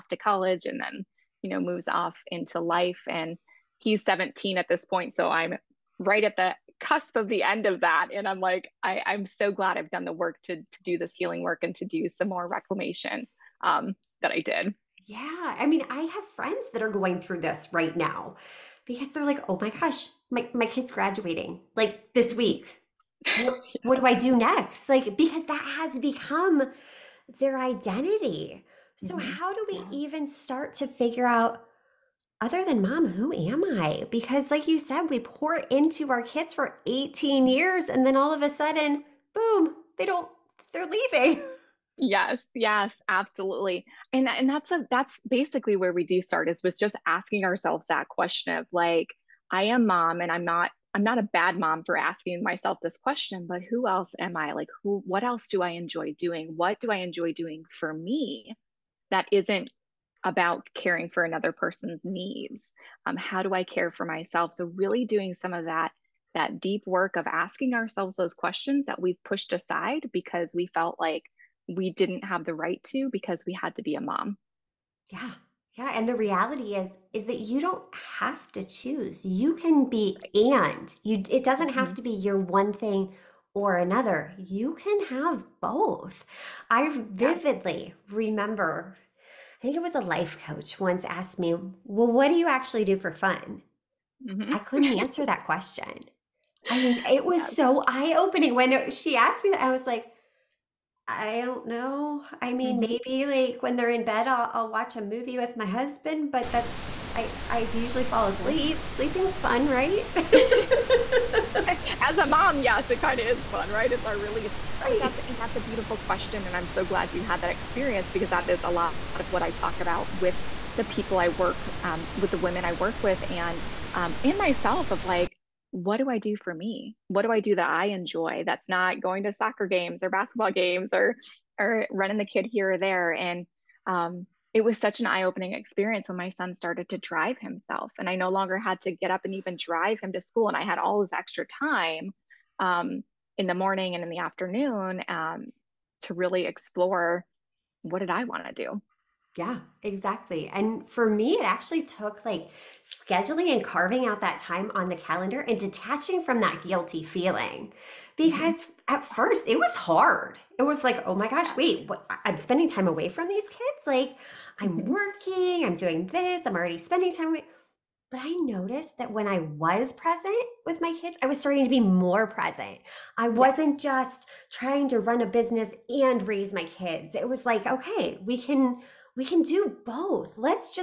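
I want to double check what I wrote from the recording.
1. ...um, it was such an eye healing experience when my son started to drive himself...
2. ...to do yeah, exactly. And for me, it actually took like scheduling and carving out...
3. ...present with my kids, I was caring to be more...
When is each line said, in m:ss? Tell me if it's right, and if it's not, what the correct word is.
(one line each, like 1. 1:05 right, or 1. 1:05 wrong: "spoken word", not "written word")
1. 2:13 wrong: "opening", not "healing"
2. 2:28 right
3. 2:49 wrong: "starting", not "caring".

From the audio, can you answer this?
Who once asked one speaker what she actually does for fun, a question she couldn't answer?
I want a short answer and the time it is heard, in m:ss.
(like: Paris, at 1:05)
Life coach, at 1:30.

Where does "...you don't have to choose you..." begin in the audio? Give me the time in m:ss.
1:17.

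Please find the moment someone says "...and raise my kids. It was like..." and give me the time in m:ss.
2:55.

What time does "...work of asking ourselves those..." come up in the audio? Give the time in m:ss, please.
1:06.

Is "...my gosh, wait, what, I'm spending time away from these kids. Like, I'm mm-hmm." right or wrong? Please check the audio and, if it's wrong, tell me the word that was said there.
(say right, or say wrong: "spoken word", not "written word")
right.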